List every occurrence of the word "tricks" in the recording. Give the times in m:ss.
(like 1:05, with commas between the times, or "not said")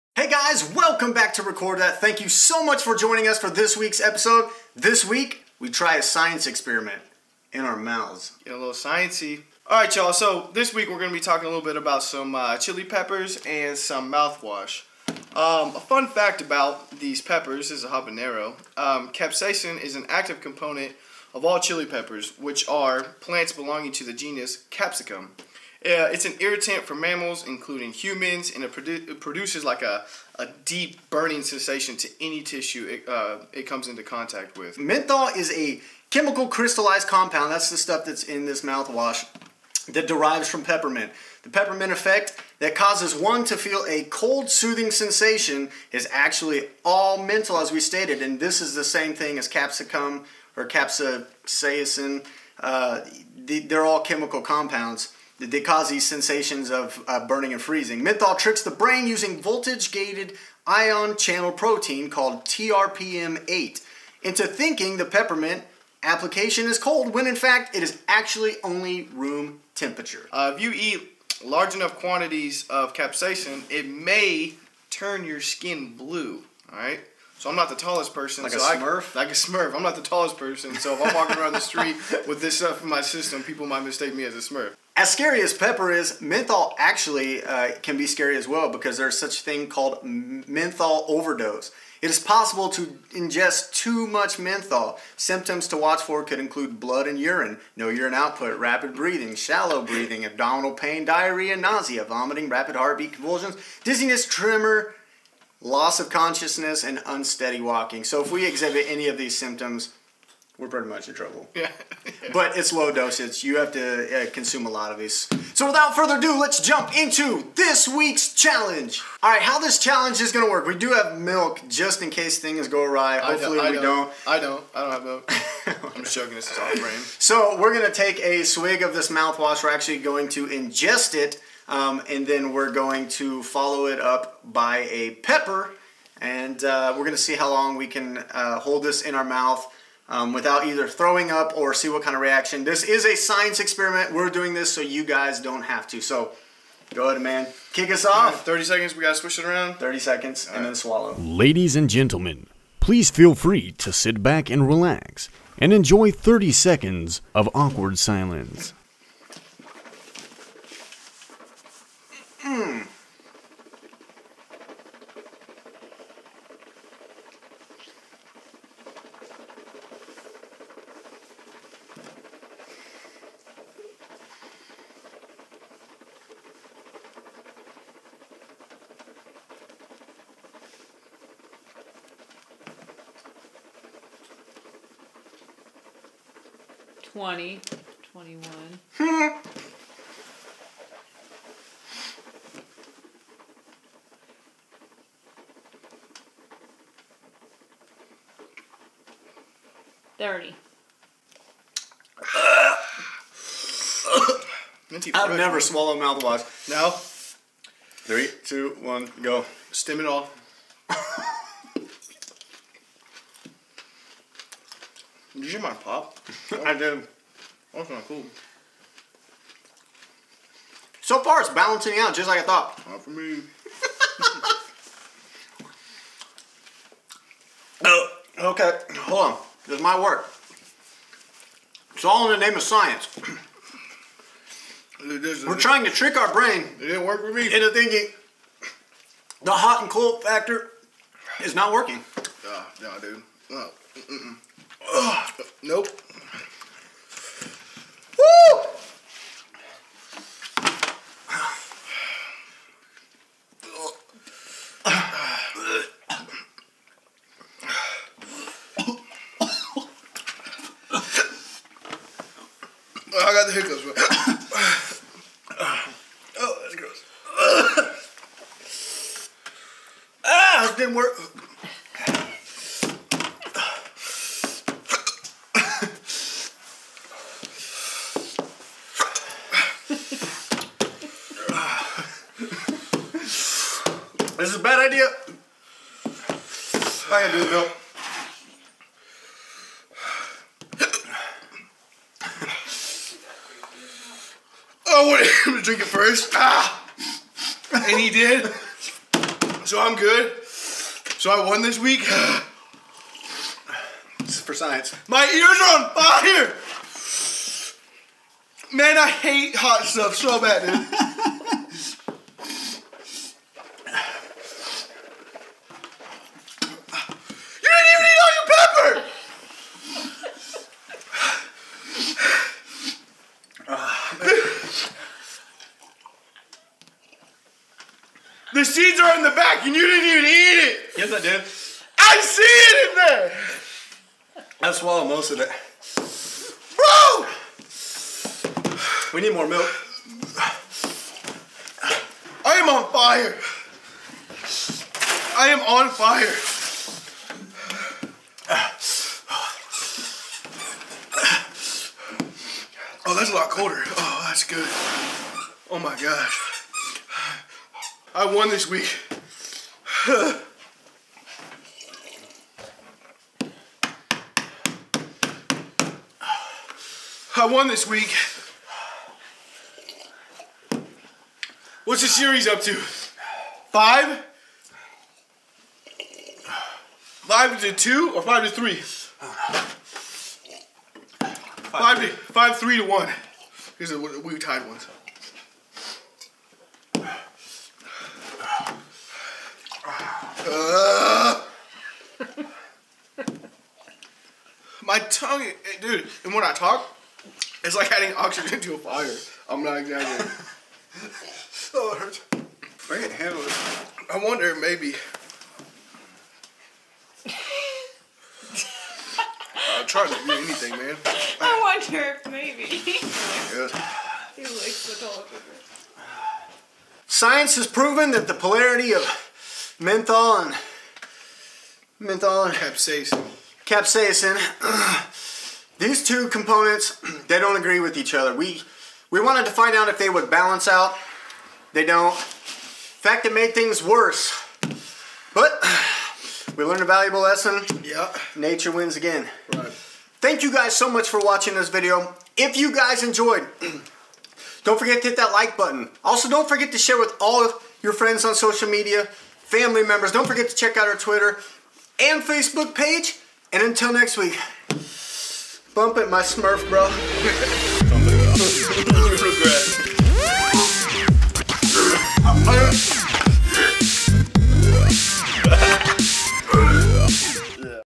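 0:58, 3:55.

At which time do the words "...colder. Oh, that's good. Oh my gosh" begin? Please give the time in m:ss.
5:53.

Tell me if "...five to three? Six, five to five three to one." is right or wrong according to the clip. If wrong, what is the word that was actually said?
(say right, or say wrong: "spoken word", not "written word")
wrong: "Five", not "Six".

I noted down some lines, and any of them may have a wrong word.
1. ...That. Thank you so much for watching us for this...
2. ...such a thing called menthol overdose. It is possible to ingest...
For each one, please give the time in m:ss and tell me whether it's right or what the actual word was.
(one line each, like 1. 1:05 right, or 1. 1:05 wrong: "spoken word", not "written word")
1. 0:01 wrong: "joining", not "watching"
2. 1:29 right.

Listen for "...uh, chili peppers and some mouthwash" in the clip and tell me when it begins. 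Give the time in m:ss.
0:12.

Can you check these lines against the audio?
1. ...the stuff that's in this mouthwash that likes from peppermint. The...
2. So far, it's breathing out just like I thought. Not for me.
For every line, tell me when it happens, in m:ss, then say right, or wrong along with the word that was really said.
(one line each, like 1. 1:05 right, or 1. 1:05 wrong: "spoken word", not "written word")
1. 0:37 wrong: "derives", not "likes"
2. 3:41 wrong: "balancing", not "breathing".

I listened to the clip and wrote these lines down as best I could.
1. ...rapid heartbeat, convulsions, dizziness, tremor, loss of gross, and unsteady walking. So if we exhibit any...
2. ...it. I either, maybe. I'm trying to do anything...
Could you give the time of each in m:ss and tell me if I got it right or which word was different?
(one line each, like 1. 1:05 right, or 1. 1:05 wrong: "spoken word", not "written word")
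1. 1:42 wrong: "consciousness", not "gross"
2. 6:43 wrong: "wonder", not "either".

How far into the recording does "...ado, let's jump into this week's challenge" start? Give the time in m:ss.
1:56.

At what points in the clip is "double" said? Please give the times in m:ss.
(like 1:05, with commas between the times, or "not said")
not said.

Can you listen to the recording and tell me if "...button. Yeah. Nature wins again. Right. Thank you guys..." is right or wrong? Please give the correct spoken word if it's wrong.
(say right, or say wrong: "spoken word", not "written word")
wrong: "lesson", not "button".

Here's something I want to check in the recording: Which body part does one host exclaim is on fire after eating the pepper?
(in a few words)
Ears.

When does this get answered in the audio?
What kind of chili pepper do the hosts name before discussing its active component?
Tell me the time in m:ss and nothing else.
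0:17.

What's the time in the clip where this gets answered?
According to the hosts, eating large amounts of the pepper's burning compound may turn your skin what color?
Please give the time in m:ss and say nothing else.
1:15.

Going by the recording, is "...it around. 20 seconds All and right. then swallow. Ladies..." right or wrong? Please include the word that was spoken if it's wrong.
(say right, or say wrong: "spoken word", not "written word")
wrong: "30", not "20".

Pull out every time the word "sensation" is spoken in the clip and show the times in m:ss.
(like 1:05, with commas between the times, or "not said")
0:31, 0:44, 0:56.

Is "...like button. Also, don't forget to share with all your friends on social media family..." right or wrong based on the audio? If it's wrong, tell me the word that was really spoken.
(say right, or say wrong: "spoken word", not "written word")
right.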